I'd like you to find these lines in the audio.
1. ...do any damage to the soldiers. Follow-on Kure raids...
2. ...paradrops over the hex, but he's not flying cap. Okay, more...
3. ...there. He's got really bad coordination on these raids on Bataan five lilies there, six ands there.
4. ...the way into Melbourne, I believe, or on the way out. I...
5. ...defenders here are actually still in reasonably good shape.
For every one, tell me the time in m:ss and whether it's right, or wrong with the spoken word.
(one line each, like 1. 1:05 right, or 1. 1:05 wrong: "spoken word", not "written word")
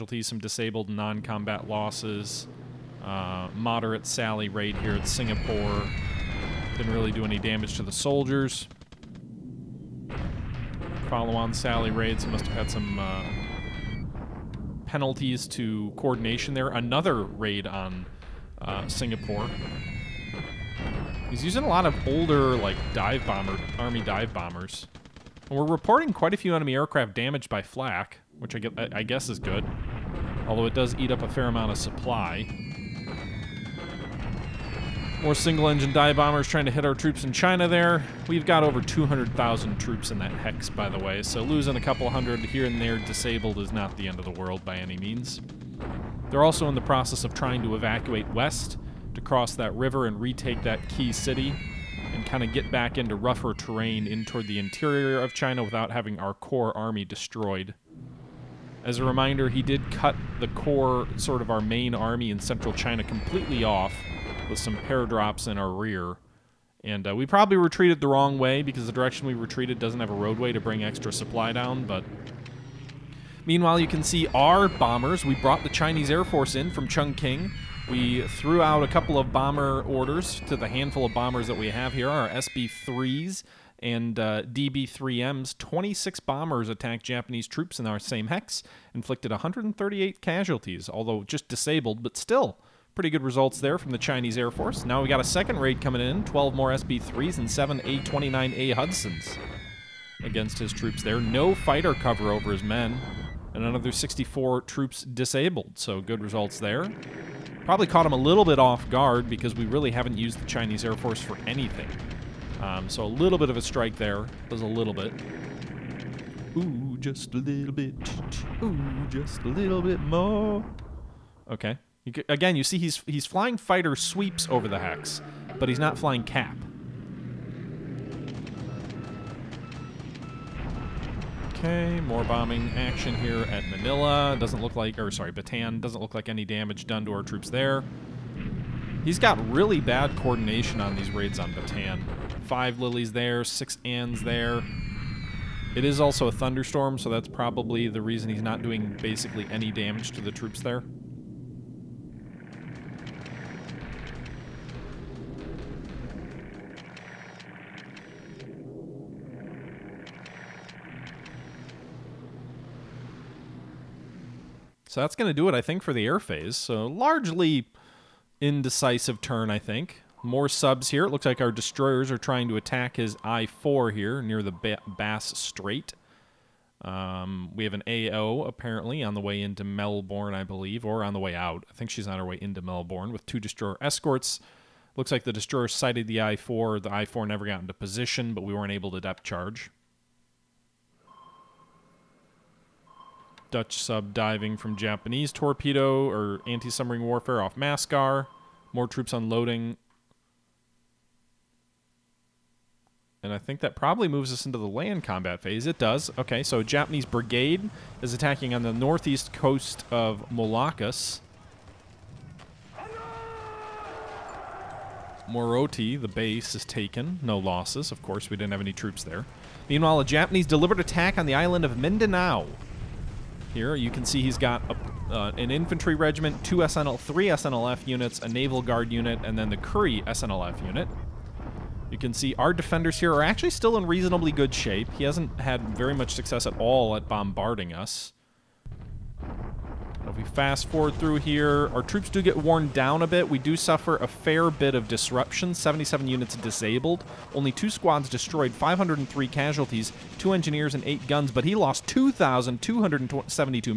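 1. 0:07 wrong: "Sally", not "Kure"
2. 2:03 wrong: "sweeps", not "paradrops"
3. 2:17 right
4. 2:59 right
5. 3:52 right.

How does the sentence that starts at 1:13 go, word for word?
Meanwhile, you can see our bombers.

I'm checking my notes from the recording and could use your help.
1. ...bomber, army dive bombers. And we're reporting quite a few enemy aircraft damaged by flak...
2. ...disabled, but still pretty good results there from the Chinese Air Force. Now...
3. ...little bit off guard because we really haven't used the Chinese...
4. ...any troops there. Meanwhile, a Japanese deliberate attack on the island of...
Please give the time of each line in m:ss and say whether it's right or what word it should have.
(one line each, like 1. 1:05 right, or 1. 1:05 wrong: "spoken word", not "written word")
1. 0:23 right
2. 1:31 right
3. 1:48 right
4. 3:38 right.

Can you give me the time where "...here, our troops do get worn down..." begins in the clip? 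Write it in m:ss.
4:01.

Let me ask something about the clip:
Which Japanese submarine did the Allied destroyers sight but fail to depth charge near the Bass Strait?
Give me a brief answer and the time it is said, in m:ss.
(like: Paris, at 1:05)
I-4, at 2:53.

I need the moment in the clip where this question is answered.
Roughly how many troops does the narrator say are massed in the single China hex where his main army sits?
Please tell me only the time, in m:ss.
0:38.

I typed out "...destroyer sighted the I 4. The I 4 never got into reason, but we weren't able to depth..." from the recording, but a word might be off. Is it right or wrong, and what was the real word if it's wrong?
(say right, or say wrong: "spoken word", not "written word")
wrong: "position", not "reason".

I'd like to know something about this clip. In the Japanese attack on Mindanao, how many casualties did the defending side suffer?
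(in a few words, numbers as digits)
503.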